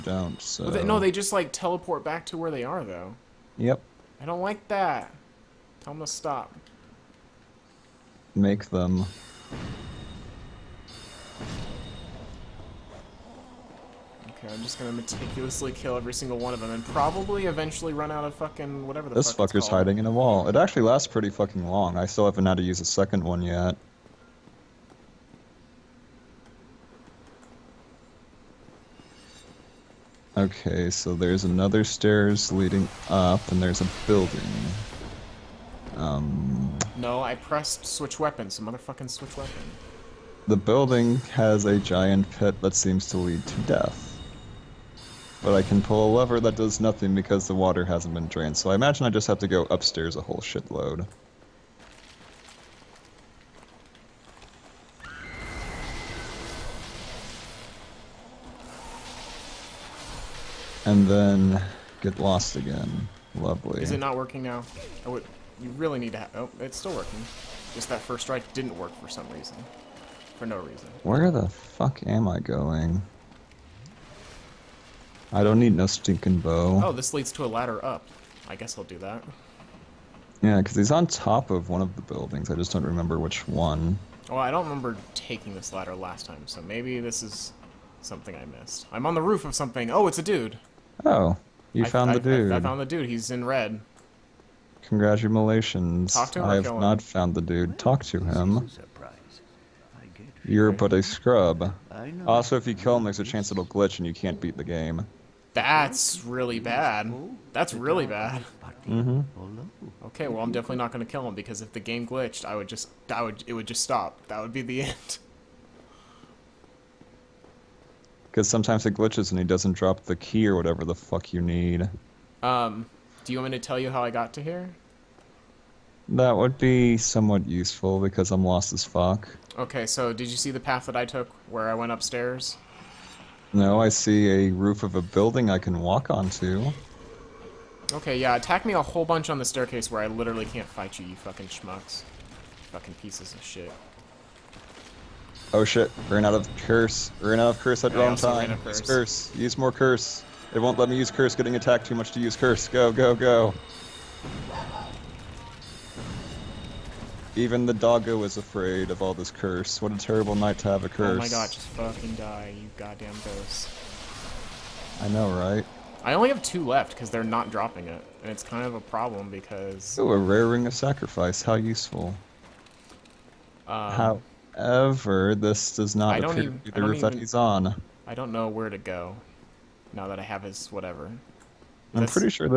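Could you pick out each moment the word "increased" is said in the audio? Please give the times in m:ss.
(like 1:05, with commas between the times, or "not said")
not said.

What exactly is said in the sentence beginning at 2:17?
Okay, yeah, attack me a whole bunch on the staircase where I literally can't fight you, you fucking schmucks.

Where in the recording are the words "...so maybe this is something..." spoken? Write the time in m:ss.
1:26.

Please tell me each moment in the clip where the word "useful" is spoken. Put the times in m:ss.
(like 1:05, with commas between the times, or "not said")
2:07, 2:51.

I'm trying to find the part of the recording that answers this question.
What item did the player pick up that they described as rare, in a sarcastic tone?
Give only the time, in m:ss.
2:50.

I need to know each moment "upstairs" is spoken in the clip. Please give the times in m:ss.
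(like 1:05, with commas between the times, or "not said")
0:49, 2:11.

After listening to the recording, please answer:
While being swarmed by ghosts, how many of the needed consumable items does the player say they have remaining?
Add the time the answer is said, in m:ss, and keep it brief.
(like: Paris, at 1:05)
2, at 2:46.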